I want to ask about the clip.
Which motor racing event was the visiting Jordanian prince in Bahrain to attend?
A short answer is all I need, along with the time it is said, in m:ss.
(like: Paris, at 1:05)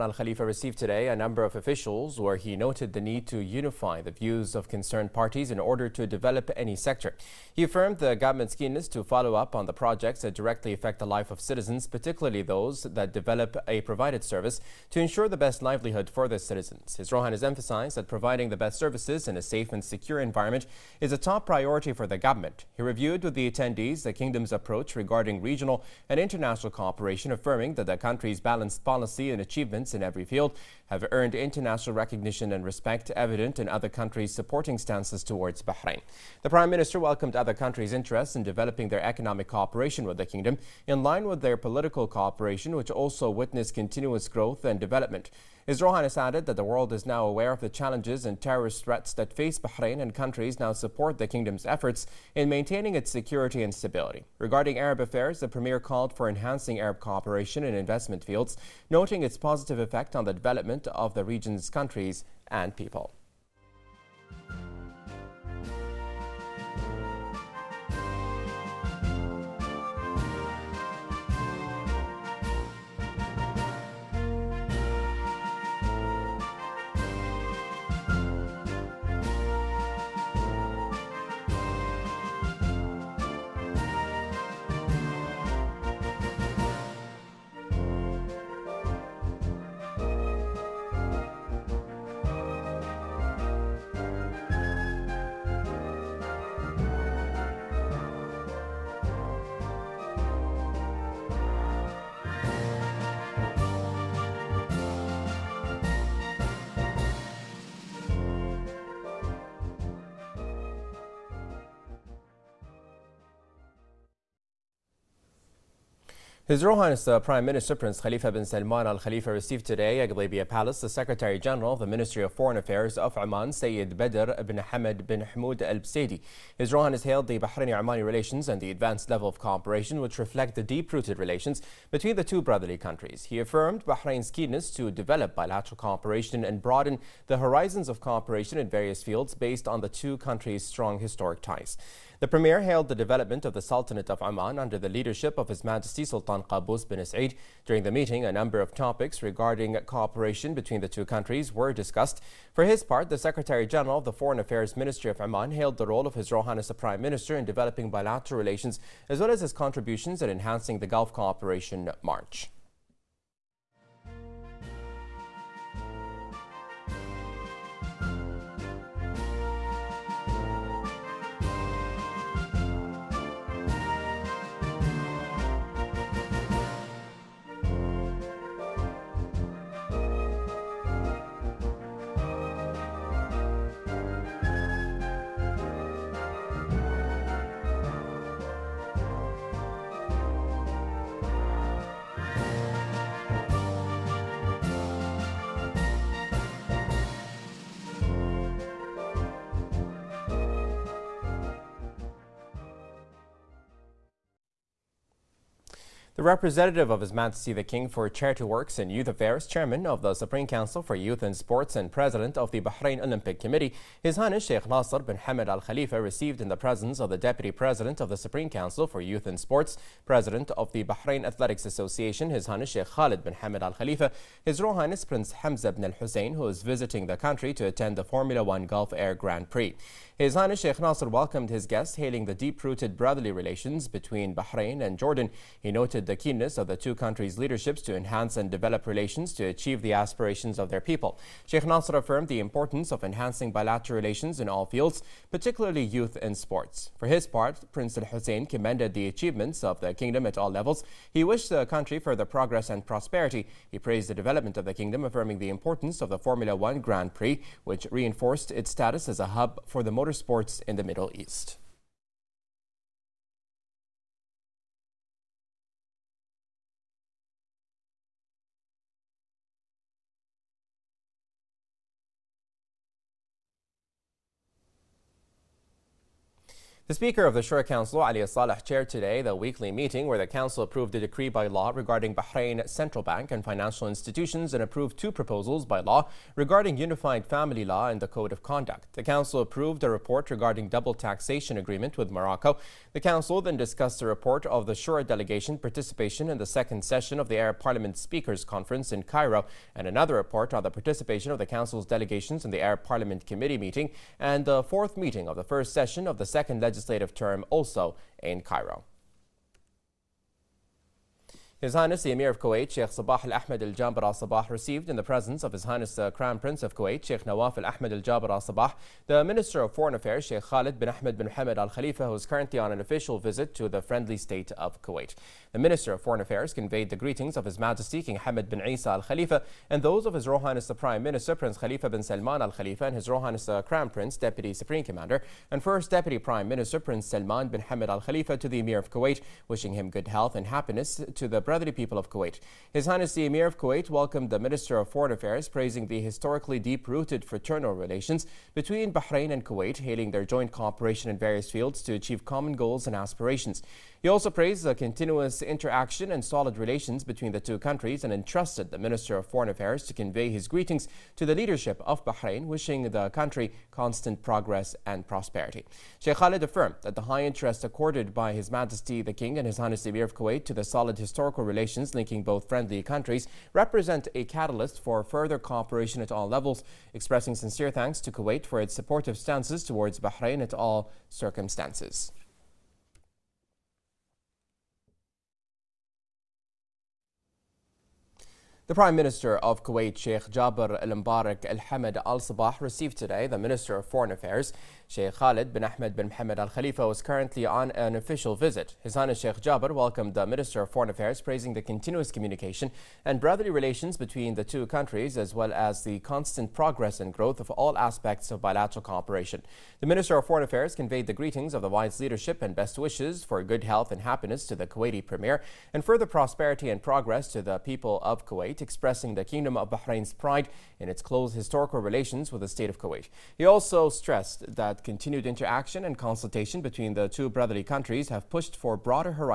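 Formula One Gulf Air Grand Prix, at 3:48.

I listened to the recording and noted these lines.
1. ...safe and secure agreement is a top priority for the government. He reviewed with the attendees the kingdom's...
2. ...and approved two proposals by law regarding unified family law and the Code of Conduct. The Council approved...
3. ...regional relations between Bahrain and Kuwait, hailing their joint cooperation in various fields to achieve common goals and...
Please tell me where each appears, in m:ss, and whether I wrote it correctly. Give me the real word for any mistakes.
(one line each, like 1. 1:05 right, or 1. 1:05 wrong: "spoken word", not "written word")
1. 0:19 wrong: "environment", not "agreement"
2. 4:44 right
3. 5:47 wrong: "fraternal", not "regional".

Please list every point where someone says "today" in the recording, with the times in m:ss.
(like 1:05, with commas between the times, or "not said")
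0:00, 1:59, 4:38, 6:32.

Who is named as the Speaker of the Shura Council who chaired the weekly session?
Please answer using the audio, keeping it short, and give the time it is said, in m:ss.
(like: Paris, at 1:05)
Ali Salah, at 4:38.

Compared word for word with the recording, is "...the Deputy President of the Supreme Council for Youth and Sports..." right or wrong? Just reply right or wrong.
right.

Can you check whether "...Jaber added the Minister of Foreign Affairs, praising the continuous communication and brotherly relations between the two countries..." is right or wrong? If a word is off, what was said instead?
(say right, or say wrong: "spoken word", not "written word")
wrong: "welcomed", not "added".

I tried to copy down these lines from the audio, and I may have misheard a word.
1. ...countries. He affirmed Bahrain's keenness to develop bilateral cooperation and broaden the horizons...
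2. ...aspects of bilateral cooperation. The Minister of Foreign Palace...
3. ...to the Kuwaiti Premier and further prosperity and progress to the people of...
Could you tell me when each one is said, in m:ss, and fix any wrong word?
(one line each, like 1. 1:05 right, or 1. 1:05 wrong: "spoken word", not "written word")
1. 2:12 right
2. 6:47 wrong: "Affairs", not "Palace"
3. 6:54 right.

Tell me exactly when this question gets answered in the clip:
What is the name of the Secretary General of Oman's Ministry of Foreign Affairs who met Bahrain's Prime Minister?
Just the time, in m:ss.
2:03.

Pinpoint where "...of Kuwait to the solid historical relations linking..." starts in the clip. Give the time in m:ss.
6:10.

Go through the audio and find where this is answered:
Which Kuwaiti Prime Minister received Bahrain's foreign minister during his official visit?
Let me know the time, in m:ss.
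6:29.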